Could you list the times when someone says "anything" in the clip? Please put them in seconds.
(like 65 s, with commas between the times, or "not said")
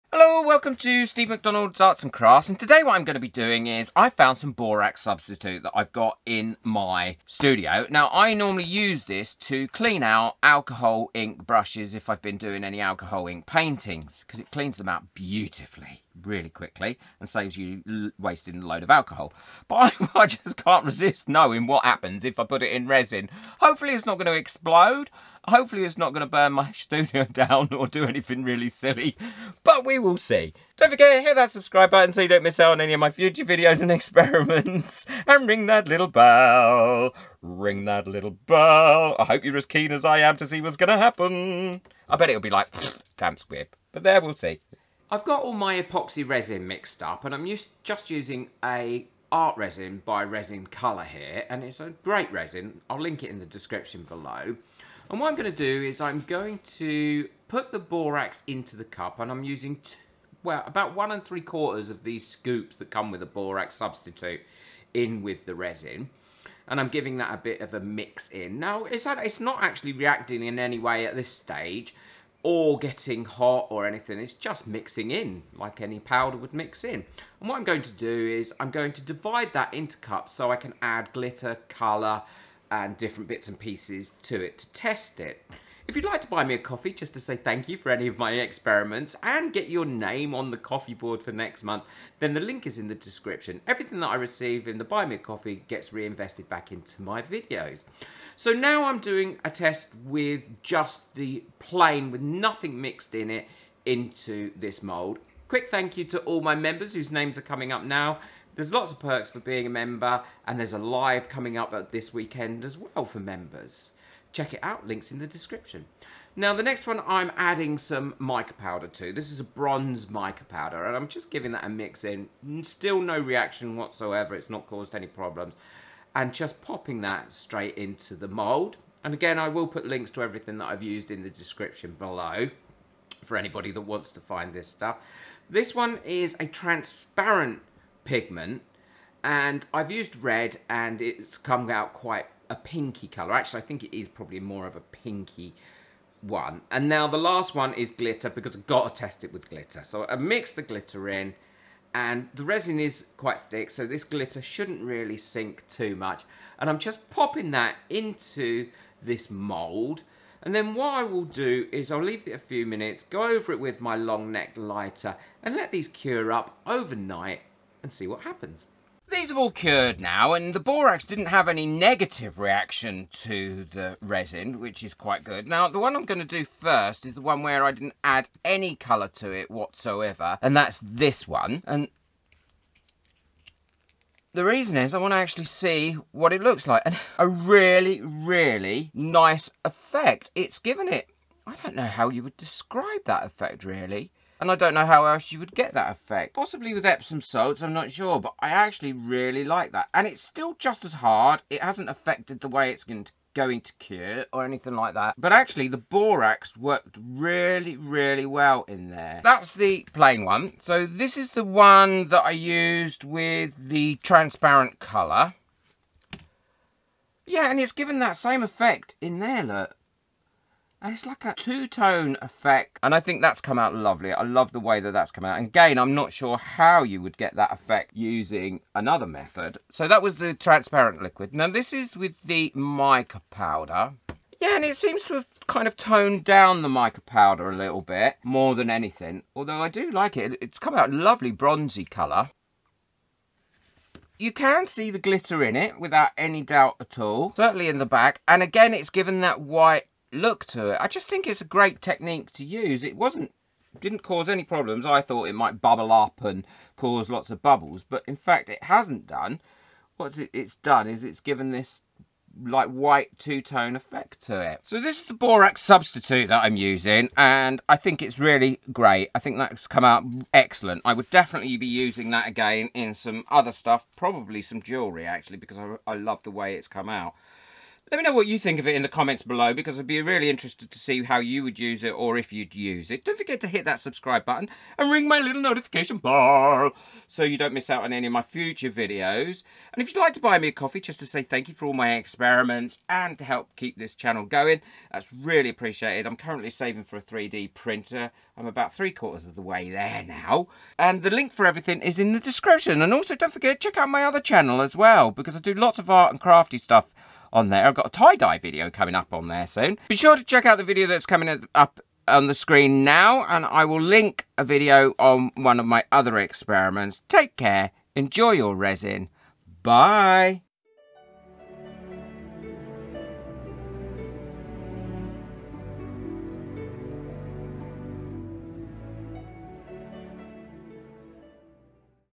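28 s, 73 s, 204 s, 238 s.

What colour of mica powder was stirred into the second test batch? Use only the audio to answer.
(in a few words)
Bronze.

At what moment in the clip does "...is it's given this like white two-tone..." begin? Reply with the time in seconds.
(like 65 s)
260 s.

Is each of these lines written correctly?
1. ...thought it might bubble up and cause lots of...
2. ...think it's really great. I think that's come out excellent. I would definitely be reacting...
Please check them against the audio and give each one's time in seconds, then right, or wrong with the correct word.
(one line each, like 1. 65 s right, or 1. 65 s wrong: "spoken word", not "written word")
1. 255 s right
2. 267 s wrong: "using", not "reacting".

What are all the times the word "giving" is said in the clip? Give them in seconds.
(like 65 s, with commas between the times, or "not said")
66 s, 121 s.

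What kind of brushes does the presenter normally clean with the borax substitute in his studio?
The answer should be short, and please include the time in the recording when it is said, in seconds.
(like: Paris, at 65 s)
Alcohol ink brushes, at 10 s.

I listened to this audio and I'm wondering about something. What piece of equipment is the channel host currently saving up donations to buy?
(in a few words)
A 3D printer.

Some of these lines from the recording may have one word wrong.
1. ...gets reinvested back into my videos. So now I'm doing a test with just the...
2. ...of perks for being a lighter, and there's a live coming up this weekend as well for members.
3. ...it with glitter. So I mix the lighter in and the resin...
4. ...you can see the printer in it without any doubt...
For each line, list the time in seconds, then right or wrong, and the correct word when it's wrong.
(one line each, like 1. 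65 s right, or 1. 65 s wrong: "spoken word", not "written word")
1. 95 s right
2. 108 s wrong: "member", not "lighter"
3. 149 s wrong: "glitter", not "lighter"
4. 244 s wrong: "glitter", not "printer".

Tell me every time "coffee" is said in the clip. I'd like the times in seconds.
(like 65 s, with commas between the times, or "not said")
86 s, 90 s, 95 s, 290 s.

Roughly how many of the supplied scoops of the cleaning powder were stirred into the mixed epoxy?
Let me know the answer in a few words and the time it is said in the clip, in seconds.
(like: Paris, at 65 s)
1 and 3/4, at 60 s.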